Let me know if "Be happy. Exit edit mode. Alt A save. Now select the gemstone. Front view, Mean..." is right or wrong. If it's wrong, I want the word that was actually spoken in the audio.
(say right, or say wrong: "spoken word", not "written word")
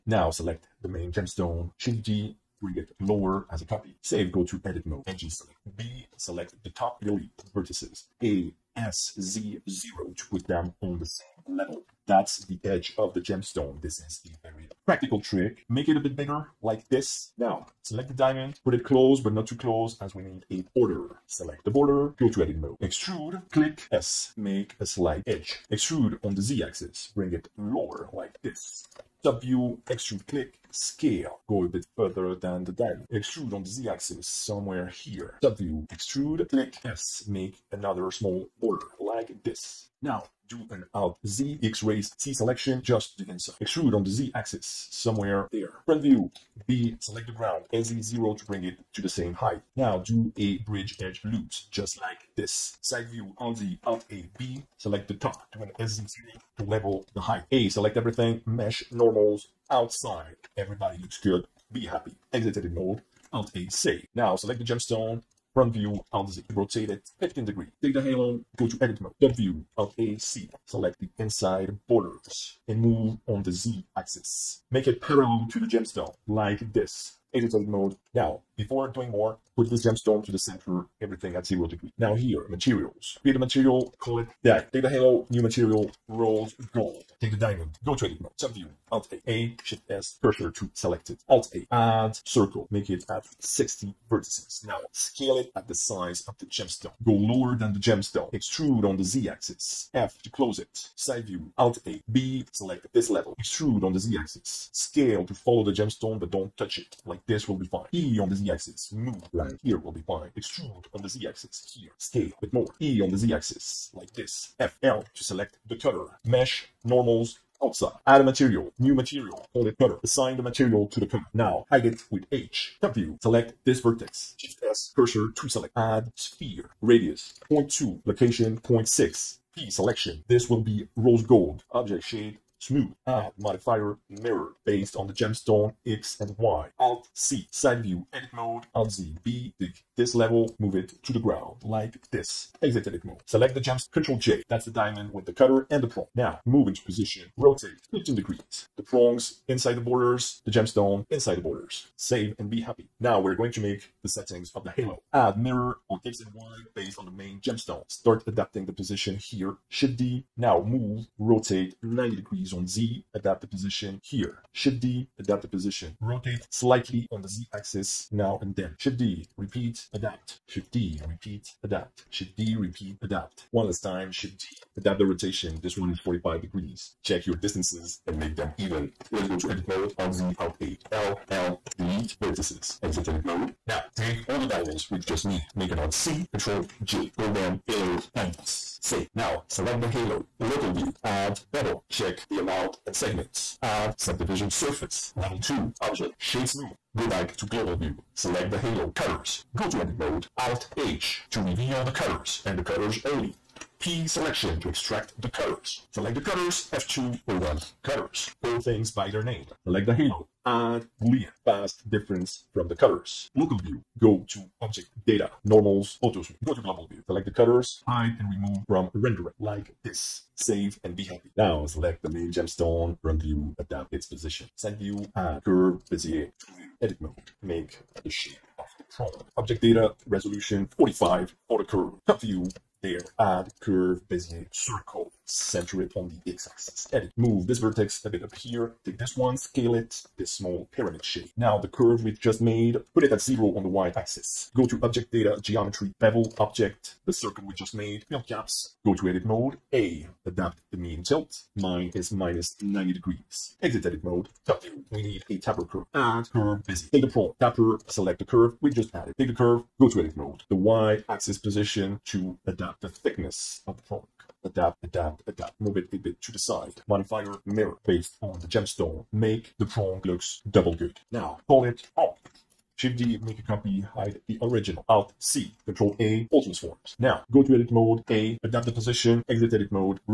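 wrong: "Alt", not "Mean".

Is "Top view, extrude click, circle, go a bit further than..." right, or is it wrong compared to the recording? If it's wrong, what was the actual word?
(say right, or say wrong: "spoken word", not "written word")
wrong: "scale", not "circle".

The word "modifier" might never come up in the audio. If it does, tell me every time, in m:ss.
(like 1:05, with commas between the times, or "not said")
2:13, 4:26.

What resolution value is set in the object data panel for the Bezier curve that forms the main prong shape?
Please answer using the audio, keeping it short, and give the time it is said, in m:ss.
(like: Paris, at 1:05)
45, at 3:50.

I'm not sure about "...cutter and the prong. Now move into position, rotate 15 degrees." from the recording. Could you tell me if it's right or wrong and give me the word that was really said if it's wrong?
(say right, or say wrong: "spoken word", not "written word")
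right.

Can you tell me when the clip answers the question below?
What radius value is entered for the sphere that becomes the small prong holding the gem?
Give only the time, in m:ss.
2:06.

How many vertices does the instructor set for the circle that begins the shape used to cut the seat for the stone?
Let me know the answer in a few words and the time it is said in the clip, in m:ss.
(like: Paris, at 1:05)
60, at 1:33.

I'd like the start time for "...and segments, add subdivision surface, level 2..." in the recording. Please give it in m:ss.
3:12.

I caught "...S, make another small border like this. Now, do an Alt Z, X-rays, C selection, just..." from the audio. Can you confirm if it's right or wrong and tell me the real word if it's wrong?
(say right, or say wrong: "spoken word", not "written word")
right.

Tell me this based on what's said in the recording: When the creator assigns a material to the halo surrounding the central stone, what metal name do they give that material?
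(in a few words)
rolled gold.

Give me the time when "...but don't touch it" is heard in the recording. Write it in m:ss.
1:46.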